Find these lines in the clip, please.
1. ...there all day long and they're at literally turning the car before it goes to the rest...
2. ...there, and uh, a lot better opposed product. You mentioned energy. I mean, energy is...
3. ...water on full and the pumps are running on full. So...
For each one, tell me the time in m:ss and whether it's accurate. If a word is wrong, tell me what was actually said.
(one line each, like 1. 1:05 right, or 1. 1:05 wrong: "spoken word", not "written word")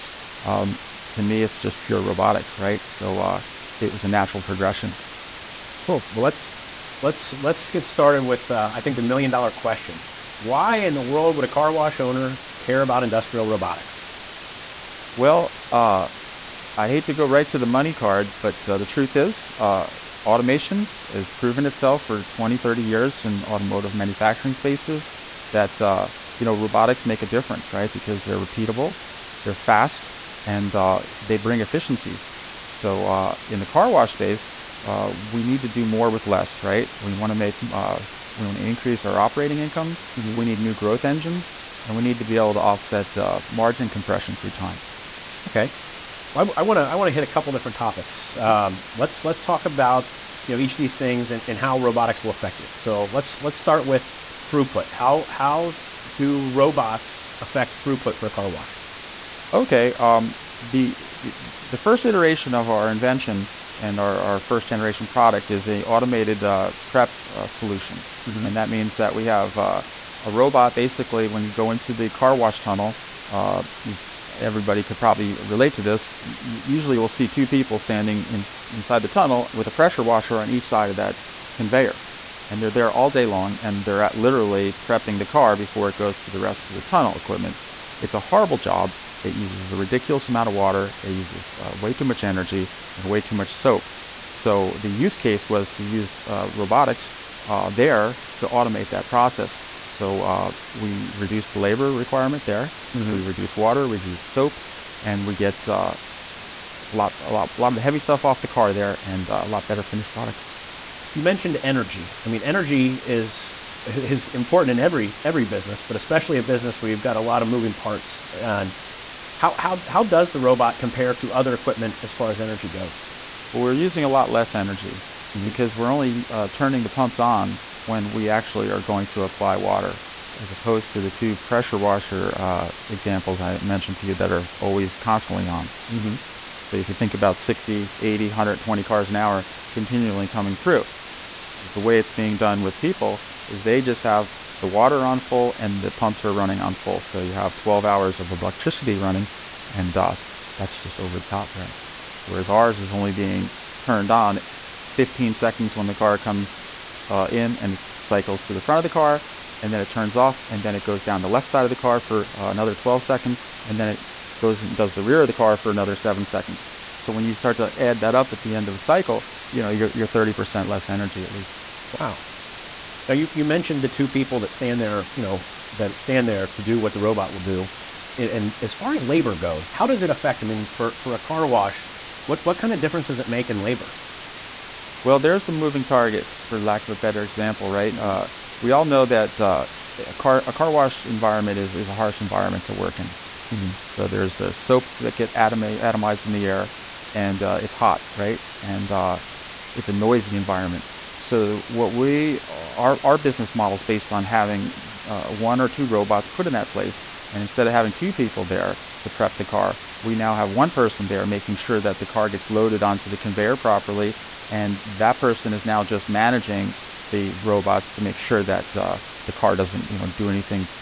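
1. 1:22 wrong: "prepping", not "turning"
2. 1:48 wrong: "finished", not "opposed"
3. 2:24 right.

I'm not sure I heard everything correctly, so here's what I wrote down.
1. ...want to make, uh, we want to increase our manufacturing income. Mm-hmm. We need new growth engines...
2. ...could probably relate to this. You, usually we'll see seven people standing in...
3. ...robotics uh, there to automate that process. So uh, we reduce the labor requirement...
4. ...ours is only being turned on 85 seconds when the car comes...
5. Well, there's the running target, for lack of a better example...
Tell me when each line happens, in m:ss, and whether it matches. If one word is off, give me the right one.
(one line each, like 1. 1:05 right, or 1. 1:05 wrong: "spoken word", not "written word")
1. 0:37 wrong: "operating", not "manufacturing"
2. 1:14 wrong: "two", not "seven"
3. 1:36 right
4. 2:32 wrong: "15", not "85"
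5. 3:05 wrong: "moving", not "running".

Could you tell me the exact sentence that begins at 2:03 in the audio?
Well, we're using a lot less energy mm-hmm.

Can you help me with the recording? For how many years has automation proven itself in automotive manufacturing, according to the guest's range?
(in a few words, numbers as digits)
20 to 30 years.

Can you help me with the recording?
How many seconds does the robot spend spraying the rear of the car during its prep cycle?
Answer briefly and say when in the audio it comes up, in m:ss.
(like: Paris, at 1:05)
7 seconds, at 2:45.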